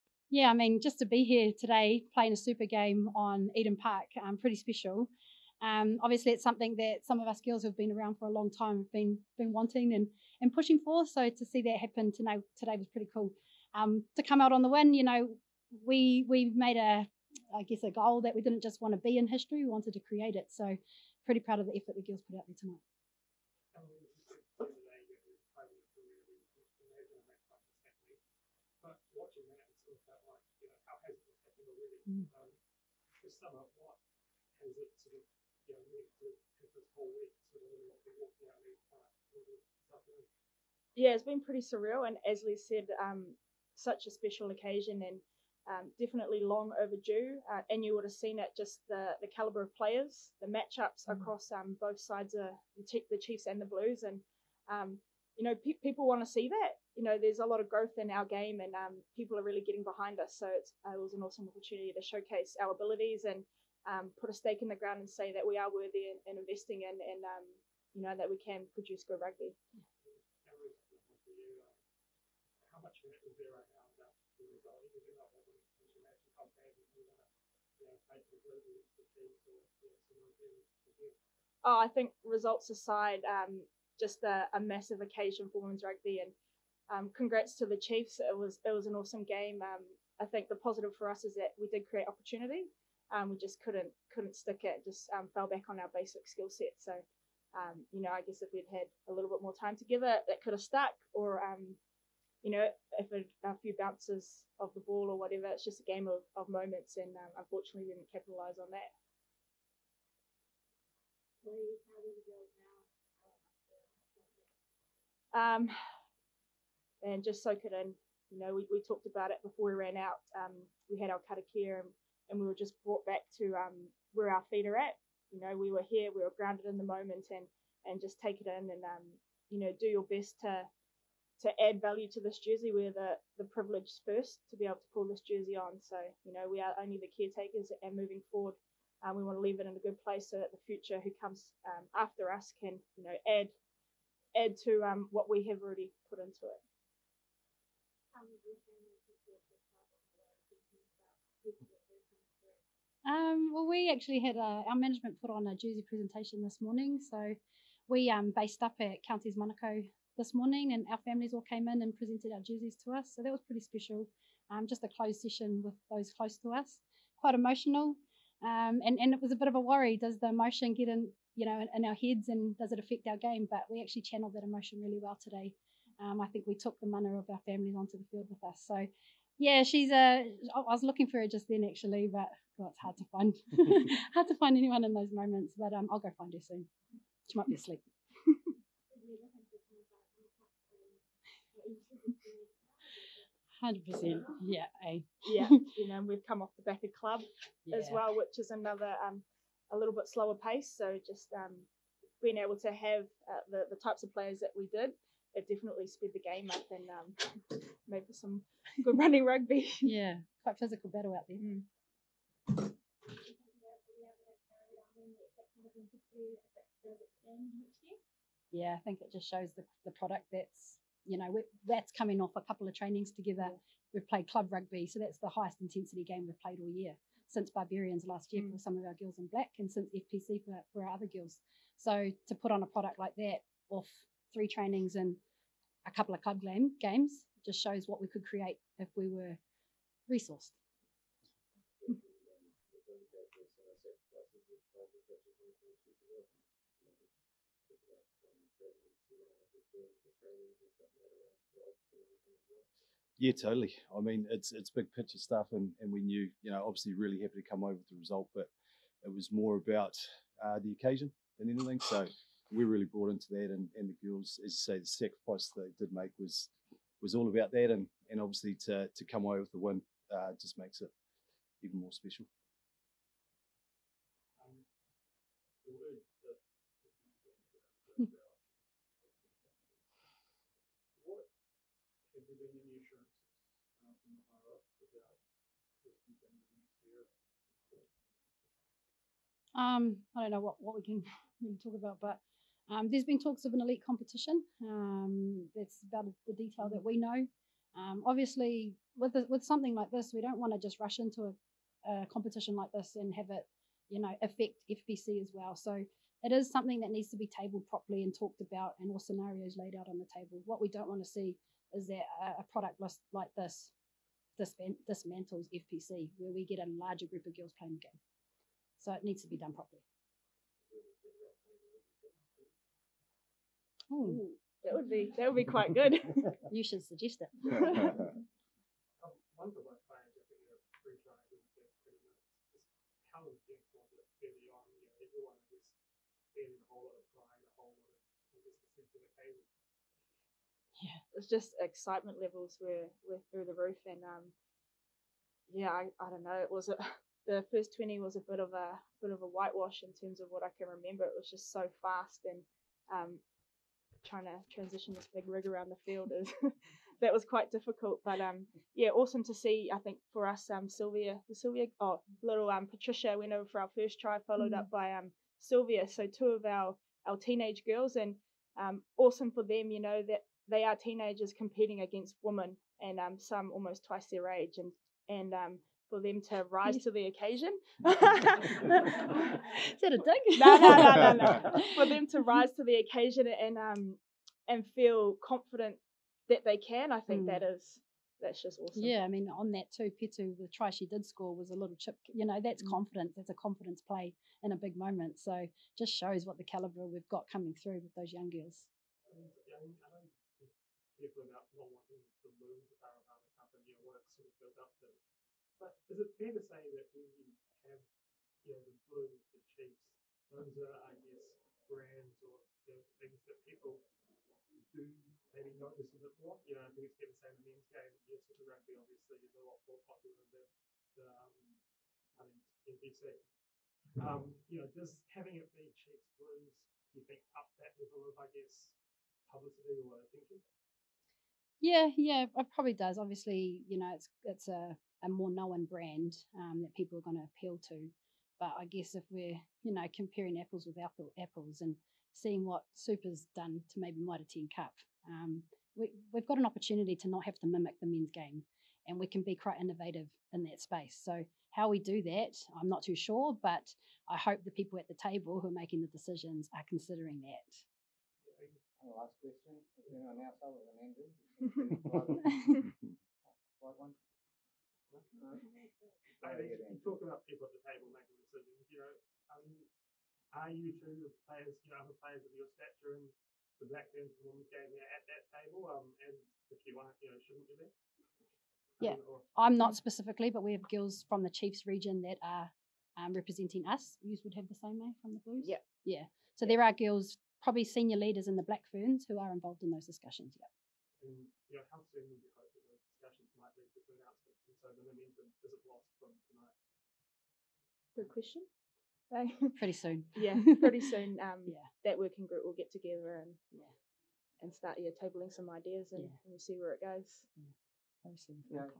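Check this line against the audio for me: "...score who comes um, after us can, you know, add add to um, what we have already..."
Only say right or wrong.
wrong.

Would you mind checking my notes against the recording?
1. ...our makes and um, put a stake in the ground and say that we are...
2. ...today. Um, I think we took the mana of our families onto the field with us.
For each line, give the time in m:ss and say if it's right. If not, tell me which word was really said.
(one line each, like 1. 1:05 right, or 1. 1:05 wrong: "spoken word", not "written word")
1. 1:02 wrong: "abilities", not "makes"
2. 2:55 right.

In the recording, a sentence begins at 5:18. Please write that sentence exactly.
So it needs to be done properly.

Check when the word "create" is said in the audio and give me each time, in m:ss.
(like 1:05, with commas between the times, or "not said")
0:19, 1:31, 3:58.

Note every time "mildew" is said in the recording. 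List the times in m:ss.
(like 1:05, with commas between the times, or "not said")
not said.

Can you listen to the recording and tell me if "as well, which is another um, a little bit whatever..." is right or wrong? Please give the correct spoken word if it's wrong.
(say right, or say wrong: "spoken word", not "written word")
wrong: "slower", not "whatever".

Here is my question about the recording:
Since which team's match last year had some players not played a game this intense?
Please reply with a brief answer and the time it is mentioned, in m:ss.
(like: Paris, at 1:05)
Barbarians, at 3:47.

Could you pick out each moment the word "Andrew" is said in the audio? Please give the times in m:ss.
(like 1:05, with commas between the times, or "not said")
7:42.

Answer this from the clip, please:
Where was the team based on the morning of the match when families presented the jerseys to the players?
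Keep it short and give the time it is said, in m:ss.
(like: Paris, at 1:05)
Counties Manukau, at 2:39.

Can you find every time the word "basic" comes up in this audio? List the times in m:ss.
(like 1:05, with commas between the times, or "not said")
1:35.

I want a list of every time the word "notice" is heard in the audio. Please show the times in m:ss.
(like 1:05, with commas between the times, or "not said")
6:55.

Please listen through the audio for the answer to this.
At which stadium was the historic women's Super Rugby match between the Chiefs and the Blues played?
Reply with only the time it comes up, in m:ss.
0:03.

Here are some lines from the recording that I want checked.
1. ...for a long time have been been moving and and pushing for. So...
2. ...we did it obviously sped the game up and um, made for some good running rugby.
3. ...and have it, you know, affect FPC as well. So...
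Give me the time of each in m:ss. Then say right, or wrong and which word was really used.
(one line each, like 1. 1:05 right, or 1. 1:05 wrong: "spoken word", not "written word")
1. 0:08 wrong: "wanting", not "moving"
2. 3:24 wrong: "definitely", not "obviously"
3. 5:02 right.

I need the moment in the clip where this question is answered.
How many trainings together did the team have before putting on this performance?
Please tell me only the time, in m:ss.
3:54.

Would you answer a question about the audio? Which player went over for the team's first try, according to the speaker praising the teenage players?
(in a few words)
Patricia.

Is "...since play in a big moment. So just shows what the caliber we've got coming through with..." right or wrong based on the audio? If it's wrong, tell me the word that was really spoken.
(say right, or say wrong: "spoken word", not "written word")
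wrong: "confidence", not "since".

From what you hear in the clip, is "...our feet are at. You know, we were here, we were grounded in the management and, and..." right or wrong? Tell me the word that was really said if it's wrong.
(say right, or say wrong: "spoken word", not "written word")
wrong: "moment", not "management".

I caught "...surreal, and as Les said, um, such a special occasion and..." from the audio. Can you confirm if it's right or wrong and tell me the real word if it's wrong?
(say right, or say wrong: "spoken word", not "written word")
right.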